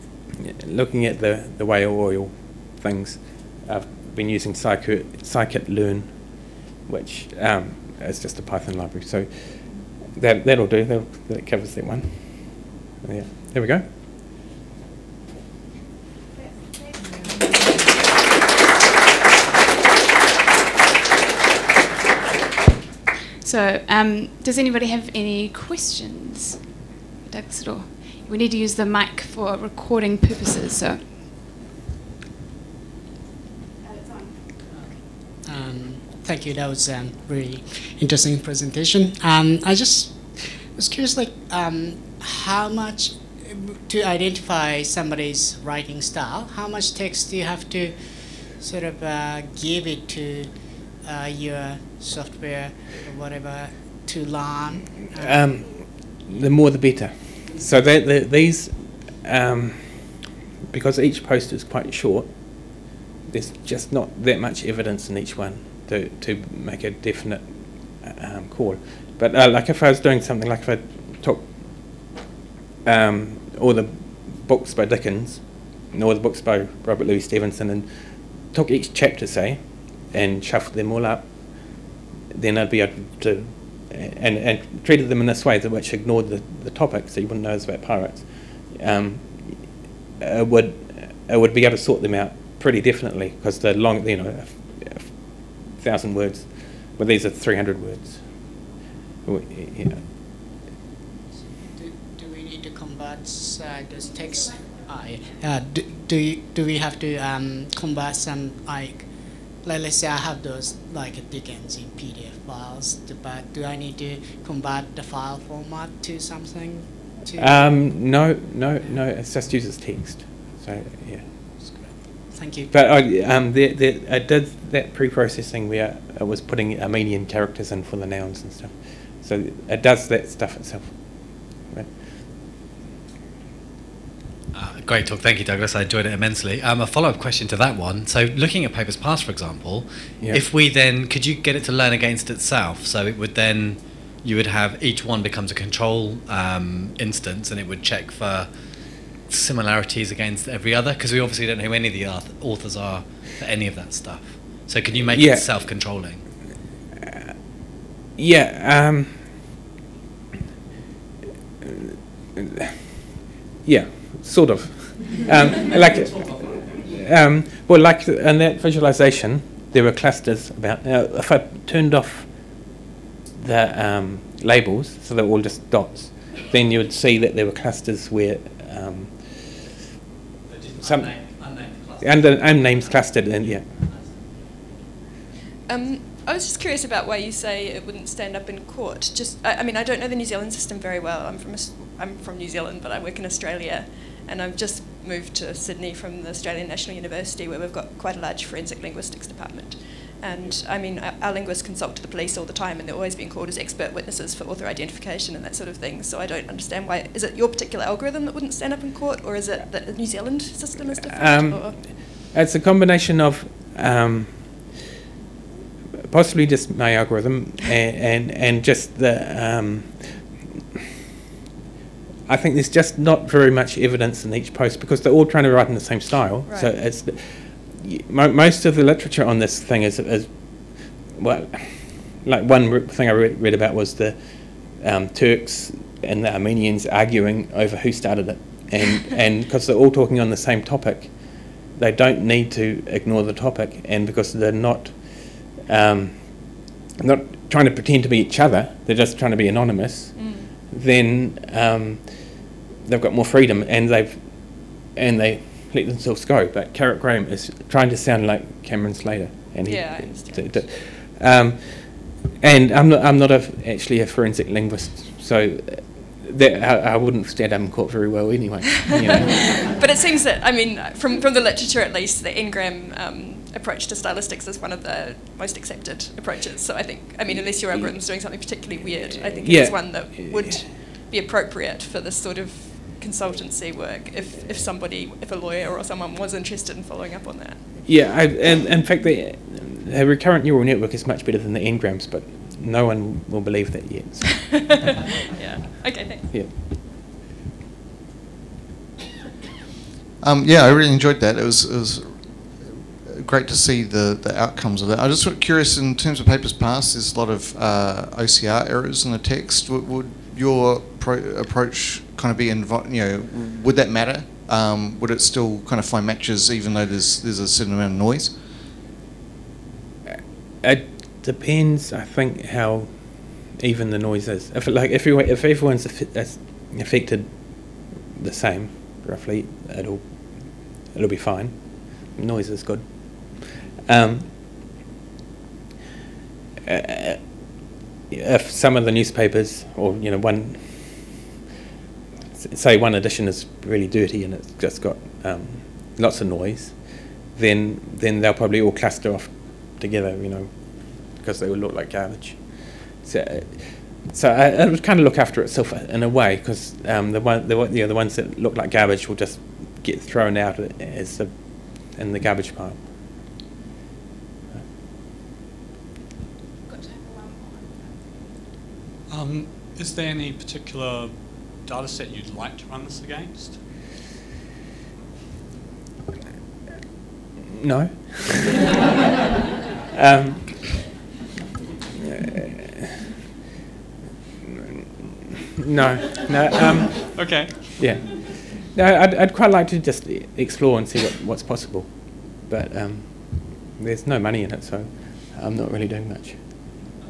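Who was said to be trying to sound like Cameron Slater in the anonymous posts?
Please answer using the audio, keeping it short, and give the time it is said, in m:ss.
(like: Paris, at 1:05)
Carrick Graham, at 4:16.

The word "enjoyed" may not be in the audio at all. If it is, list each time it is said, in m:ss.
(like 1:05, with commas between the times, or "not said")
2:15, 5:00.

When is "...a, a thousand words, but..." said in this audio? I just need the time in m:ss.
1:34.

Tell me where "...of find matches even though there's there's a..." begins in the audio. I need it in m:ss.
5:15.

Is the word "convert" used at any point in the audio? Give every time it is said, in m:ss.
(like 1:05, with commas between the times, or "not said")
1:54.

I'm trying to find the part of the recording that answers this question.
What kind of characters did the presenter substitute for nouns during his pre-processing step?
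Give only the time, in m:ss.
2:06.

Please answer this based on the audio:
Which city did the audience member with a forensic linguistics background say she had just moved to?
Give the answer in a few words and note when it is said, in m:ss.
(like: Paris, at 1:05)
Sydney, at 3:15.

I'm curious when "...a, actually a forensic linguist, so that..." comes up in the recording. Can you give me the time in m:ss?
4:23.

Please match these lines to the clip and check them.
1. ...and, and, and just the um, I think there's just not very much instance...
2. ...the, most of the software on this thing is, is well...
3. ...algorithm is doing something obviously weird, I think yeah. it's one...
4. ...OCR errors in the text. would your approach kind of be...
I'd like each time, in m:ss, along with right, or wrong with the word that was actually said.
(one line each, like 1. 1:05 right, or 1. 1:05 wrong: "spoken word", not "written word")
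1. 3:37 wrong: "evidence", not "instance"
2. 3:47 wrong: "literature", not "software"
3. 4:37 wrong: "particularly", not "obviously"
4. 5:08 right.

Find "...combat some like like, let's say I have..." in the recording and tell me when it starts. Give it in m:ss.
1:47.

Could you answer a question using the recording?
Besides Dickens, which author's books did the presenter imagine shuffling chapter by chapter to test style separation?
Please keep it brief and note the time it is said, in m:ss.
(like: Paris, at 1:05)
Robert Louis Stevenson, at 1:16.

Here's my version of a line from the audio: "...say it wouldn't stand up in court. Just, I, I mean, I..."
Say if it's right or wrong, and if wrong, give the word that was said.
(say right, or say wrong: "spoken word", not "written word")
right.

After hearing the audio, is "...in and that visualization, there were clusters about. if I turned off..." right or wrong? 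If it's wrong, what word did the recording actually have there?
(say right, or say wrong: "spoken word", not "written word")
right.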